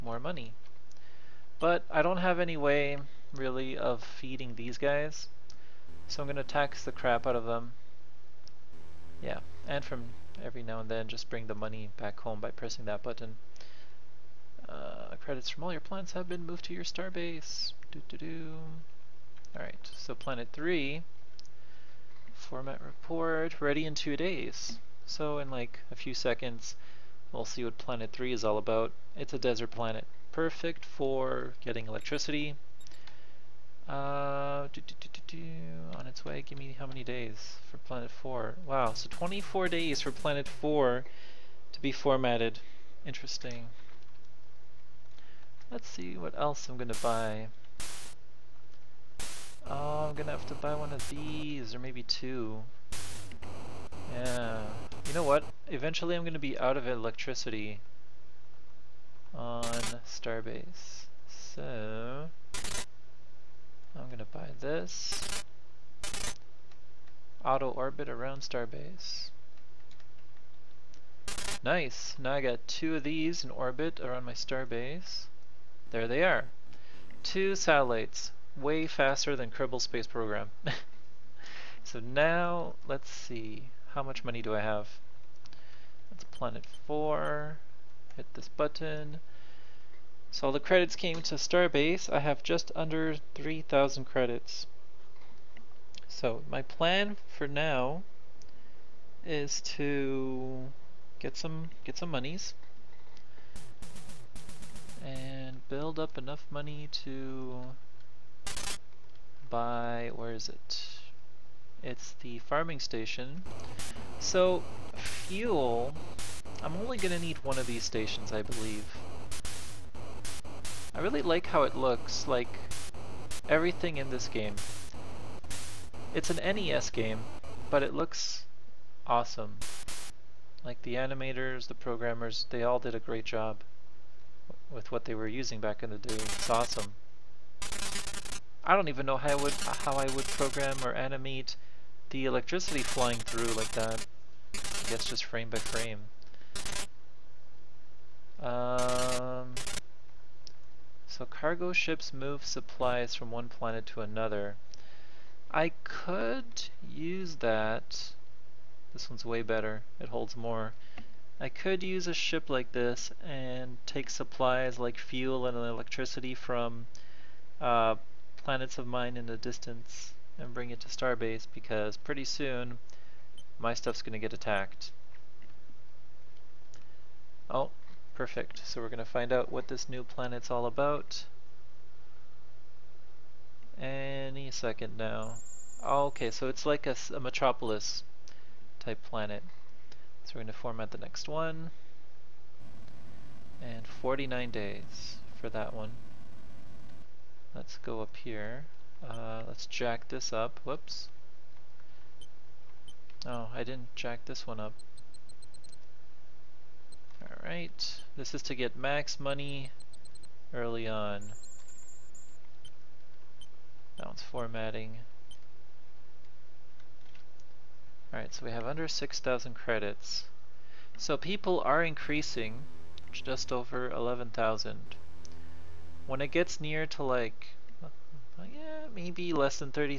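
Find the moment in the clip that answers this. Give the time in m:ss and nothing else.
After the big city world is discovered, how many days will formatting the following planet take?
3:13.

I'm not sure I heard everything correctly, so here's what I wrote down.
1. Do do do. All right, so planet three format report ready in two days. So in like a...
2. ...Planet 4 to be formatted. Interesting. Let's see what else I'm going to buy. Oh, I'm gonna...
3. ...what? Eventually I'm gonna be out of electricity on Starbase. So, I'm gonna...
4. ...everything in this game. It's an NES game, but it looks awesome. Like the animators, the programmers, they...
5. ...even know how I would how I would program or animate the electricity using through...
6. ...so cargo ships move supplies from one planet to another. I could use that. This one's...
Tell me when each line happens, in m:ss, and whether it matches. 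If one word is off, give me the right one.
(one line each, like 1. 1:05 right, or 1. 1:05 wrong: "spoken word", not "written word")
1. 0:17 right
2. 0:40 right
3. 0:55 right
4. 2:03 right
5. 2:18 wrong: "flying", not "using"
6. 2:31 right.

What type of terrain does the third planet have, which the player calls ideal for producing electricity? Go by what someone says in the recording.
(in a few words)
Desert.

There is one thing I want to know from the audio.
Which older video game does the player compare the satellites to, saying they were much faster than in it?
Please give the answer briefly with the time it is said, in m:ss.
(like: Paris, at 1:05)
Kerbal Space Program, at 1:19.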